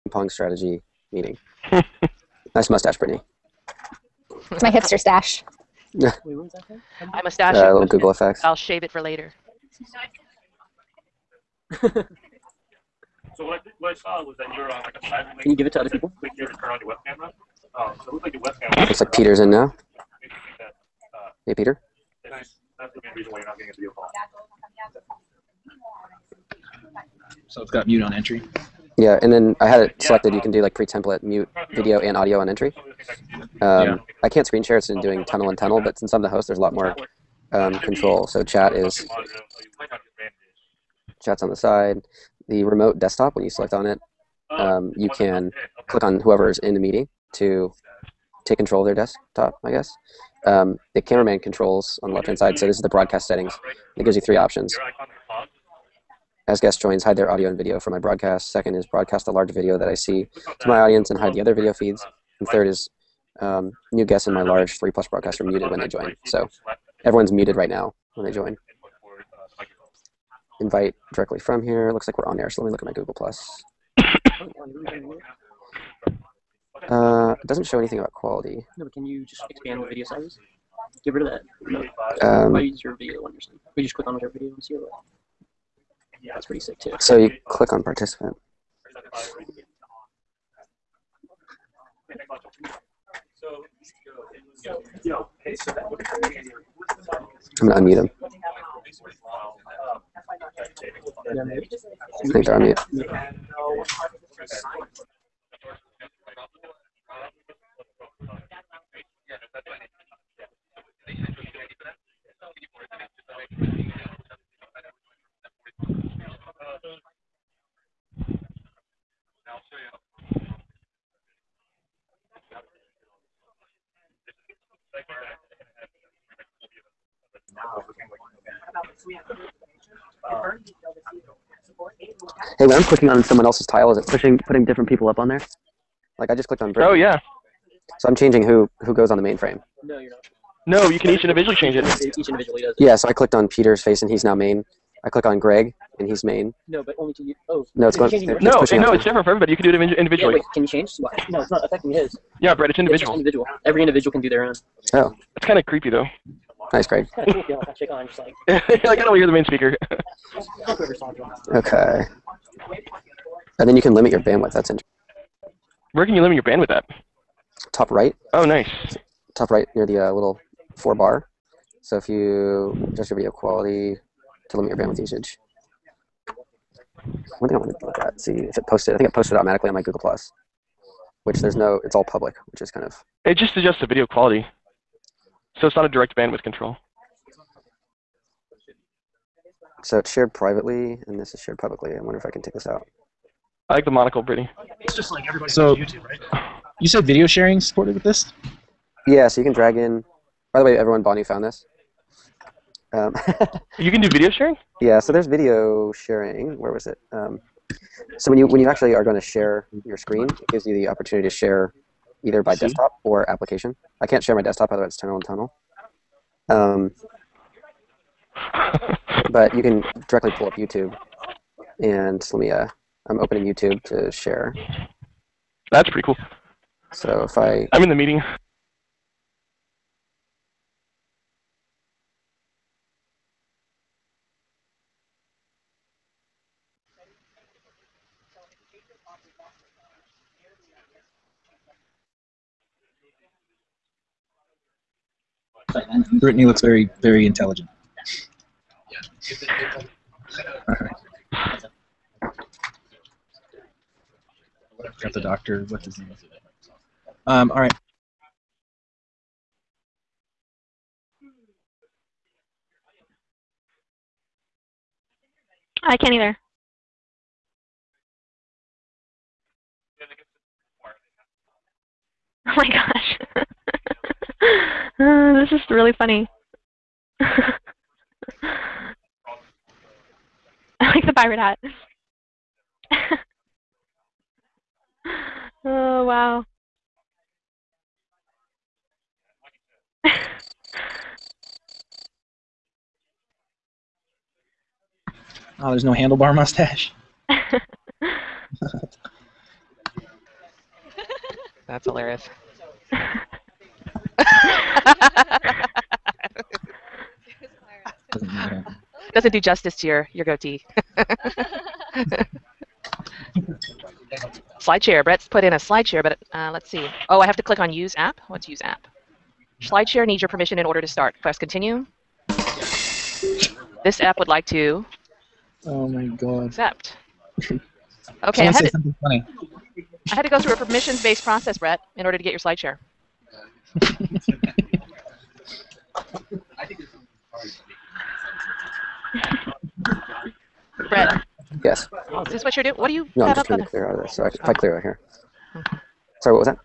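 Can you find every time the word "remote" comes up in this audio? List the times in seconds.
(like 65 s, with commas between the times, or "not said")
42 s.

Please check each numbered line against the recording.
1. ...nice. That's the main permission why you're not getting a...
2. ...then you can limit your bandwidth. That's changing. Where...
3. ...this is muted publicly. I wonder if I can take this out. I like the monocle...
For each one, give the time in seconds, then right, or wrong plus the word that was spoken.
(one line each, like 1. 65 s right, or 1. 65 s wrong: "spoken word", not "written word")
1. 22 s wrong: "reason", not "permission"
2. 163 s wrong: "interesting", not "changing"
3. 191 s wrong: "shared", not "muted".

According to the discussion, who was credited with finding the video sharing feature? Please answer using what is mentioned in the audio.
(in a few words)
Bonnie.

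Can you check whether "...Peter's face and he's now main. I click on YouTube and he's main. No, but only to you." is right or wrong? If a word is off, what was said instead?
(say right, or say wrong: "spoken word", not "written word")
wrong: "Greg", not "YouTube".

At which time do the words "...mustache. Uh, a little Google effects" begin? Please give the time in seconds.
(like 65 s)
7 s.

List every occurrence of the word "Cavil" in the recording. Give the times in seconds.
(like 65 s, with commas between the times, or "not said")
not said.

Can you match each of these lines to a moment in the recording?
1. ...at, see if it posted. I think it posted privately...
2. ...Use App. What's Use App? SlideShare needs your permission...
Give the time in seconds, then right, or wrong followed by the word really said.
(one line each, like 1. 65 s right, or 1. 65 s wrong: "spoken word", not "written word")
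1. 177 s wrong: "automatically", not "privately"
2. 317 s right.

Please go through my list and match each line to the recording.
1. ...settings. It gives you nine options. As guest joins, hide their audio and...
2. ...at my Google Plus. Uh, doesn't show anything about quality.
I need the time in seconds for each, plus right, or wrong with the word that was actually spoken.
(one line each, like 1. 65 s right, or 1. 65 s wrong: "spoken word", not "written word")
1. 53 s wrong: "three", not "nine"
2. 72 s right.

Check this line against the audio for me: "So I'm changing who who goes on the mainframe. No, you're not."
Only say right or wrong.
right.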